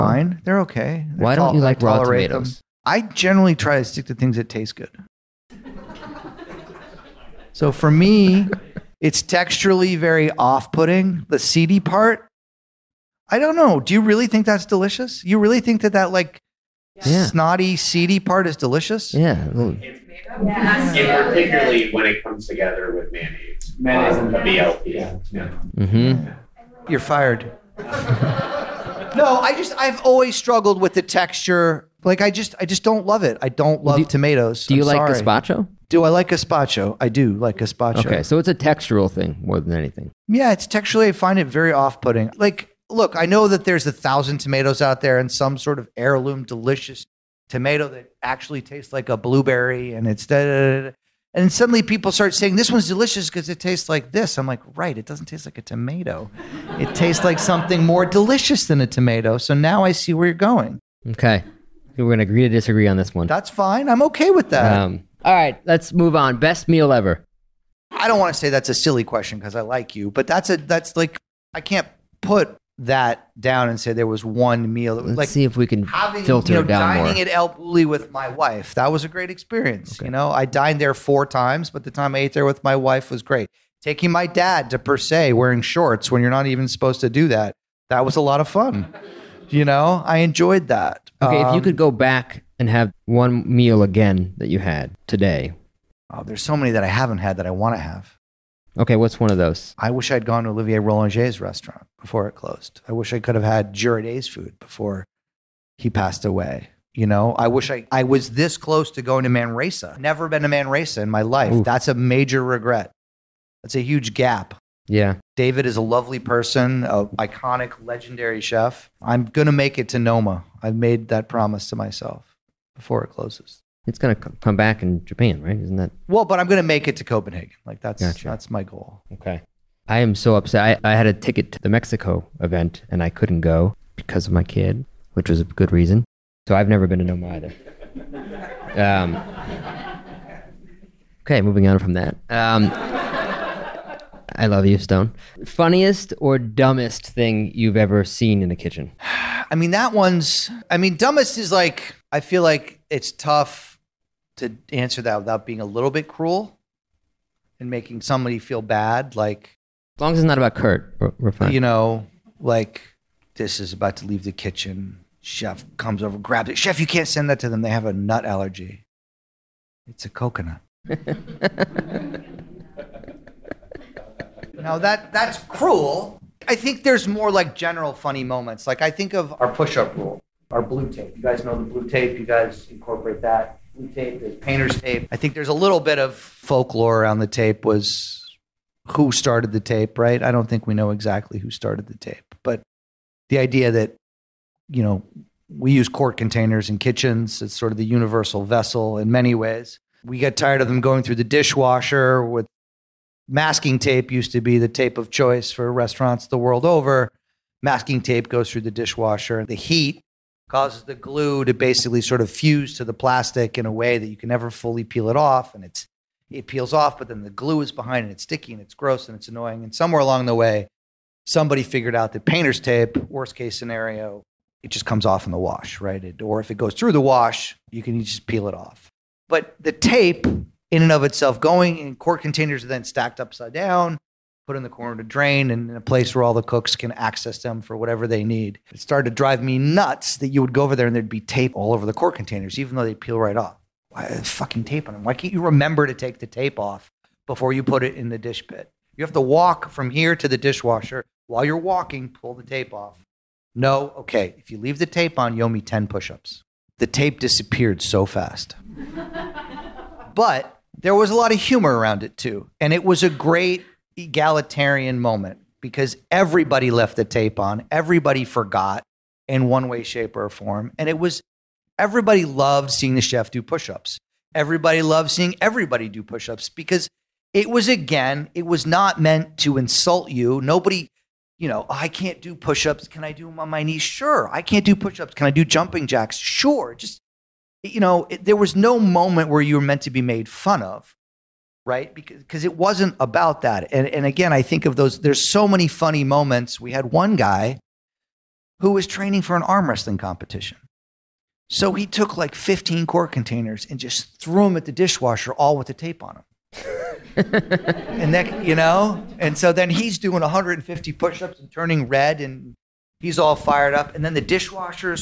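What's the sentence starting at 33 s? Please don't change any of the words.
I don't love do you, tomatoes.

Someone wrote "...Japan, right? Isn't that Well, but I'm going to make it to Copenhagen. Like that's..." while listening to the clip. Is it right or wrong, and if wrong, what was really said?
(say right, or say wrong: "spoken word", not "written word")
right.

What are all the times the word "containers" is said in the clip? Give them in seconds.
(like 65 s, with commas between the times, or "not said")
196 s, 232 s, 242 s, 303 s.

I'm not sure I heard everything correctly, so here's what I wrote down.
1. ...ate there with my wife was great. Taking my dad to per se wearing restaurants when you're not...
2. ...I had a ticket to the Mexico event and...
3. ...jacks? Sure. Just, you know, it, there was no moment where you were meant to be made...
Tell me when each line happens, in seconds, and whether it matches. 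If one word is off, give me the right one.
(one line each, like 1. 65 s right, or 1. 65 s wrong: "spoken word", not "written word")
1. 82 s wrong: "shorts", not "restaurants"
2. 130 s right
3. 285 s right.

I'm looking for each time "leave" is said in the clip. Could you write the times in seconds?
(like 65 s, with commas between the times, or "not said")
164 s, 254 s.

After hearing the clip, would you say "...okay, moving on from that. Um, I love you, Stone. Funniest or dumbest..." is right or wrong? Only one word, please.
right.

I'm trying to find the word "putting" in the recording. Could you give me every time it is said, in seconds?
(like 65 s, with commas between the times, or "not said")
10 s, 41 s.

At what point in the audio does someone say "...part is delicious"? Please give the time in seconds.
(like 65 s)
18 s.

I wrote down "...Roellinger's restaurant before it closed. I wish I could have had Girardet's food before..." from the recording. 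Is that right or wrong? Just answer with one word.
right.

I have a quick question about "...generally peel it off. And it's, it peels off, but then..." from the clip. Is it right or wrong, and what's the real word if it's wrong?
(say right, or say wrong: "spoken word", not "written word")
wrong: "fully", not "generally".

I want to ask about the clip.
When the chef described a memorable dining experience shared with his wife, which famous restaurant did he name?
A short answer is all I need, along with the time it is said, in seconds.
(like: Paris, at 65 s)
El Bulli, at 77 s.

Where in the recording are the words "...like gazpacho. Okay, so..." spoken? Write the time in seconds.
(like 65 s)
37 s.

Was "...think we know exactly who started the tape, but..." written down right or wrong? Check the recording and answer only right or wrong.
right.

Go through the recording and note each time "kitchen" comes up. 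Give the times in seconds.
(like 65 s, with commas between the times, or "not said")
148 s, 164 s, 196 s.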